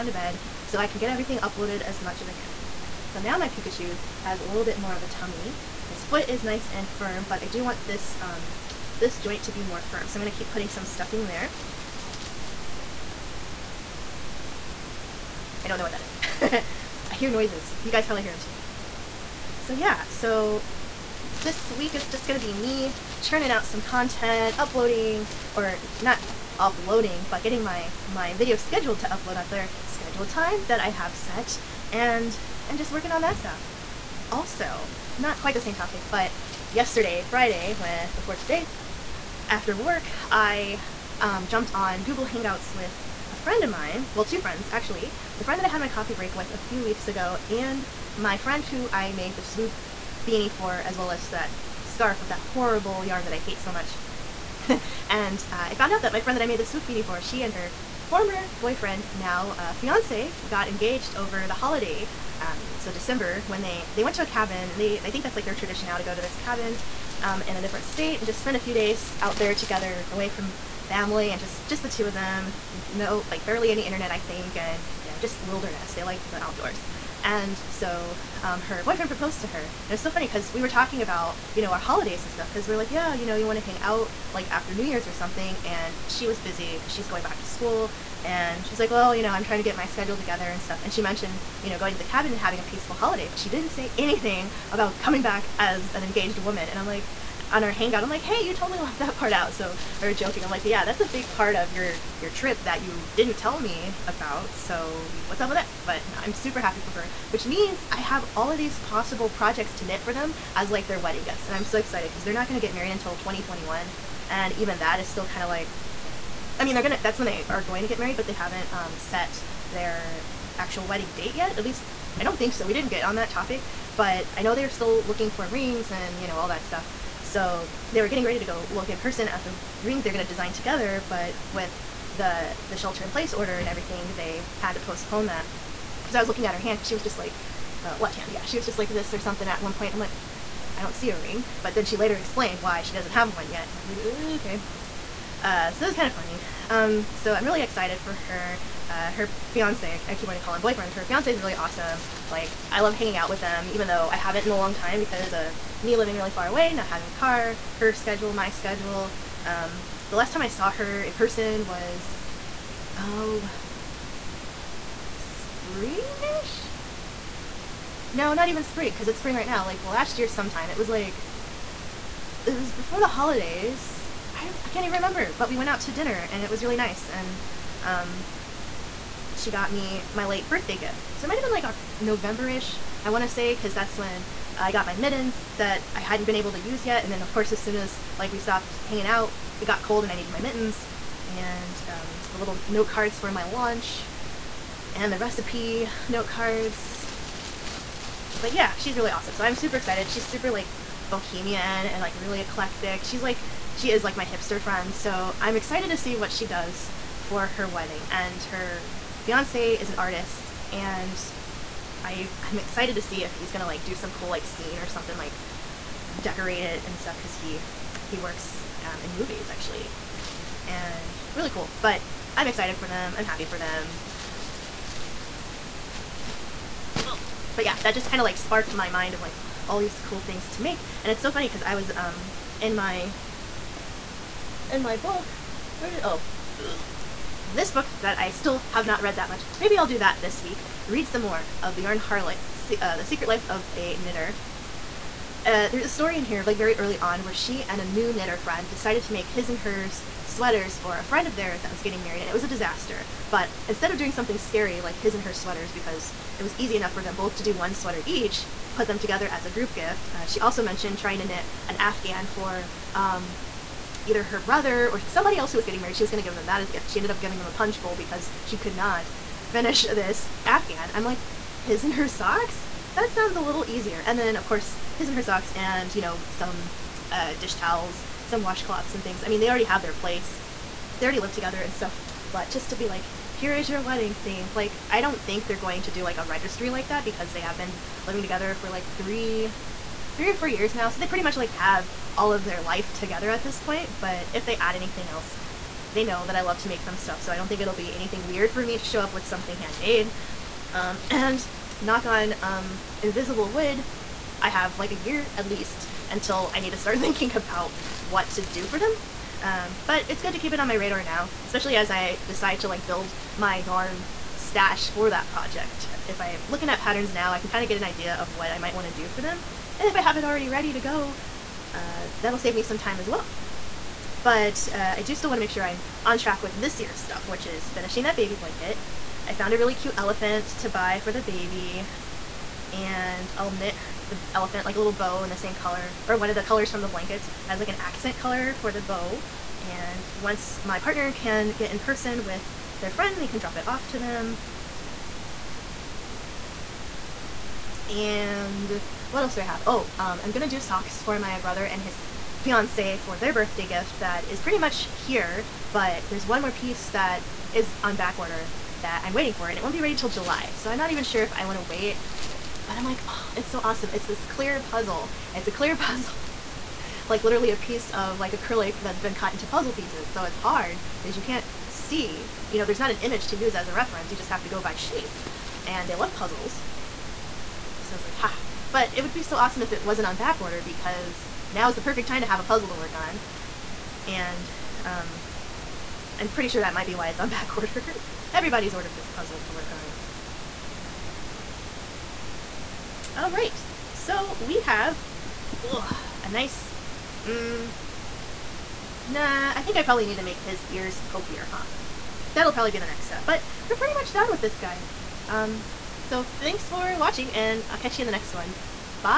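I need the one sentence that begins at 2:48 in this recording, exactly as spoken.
No, not even spring, because it's spring right now.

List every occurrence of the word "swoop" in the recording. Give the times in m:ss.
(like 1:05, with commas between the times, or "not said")
0:49, 0:56.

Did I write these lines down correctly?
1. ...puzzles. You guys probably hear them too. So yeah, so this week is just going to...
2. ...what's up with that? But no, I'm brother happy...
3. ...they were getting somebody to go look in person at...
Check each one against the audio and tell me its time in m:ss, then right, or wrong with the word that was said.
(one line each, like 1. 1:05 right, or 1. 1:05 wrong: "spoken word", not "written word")
1. 0:17 wrong: "noises", not "puzzles"
2. 1:45 wrong: "super", not "brother"
3. 2:07 wrong: "ready", not "somebody".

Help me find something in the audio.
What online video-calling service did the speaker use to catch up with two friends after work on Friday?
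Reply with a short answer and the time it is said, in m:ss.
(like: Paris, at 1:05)
Google Hangouts, at 0:42.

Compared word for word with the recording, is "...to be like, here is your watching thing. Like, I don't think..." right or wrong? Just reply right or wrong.
wrong.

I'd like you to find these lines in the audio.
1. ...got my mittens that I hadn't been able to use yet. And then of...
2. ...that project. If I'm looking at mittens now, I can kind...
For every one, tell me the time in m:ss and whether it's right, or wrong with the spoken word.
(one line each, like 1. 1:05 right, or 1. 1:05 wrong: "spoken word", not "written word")
1. 3:04 right
2. 5:15 wrong: "patterns", not "mittens".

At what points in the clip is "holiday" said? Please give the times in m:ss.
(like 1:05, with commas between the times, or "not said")
1:01, 1:21, 1:32, 2:53.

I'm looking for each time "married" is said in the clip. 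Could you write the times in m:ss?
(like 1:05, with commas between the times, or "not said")
1:52, 1:57, 4:12, 4:25.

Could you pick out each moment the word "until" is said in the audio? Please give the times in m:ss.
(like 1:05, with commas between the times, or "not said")
1:52, 5:06.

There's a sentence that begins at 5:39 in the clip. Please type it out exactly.
And once my partner can get in person with their friend, they can drop it off to them.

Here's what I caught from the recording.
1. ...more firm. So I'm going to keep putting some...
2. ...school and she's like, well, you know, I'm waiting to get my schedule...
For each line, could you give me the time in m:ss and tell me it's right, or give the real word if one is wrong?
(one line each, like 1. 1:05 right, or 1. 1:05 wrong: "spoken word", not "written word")
1. 0:09 right
2. 1:27 wrong: "trying", not "waiting".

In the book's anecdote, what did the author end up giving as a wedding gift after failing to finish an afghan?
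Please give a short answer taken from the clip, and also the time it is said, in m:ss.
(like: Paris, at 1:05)
a punch bowl, at 4:27.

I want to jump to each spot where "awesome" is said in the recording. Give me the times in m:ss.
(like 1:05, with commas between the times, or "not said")
2:31, 3:19, 6:03, 6:19.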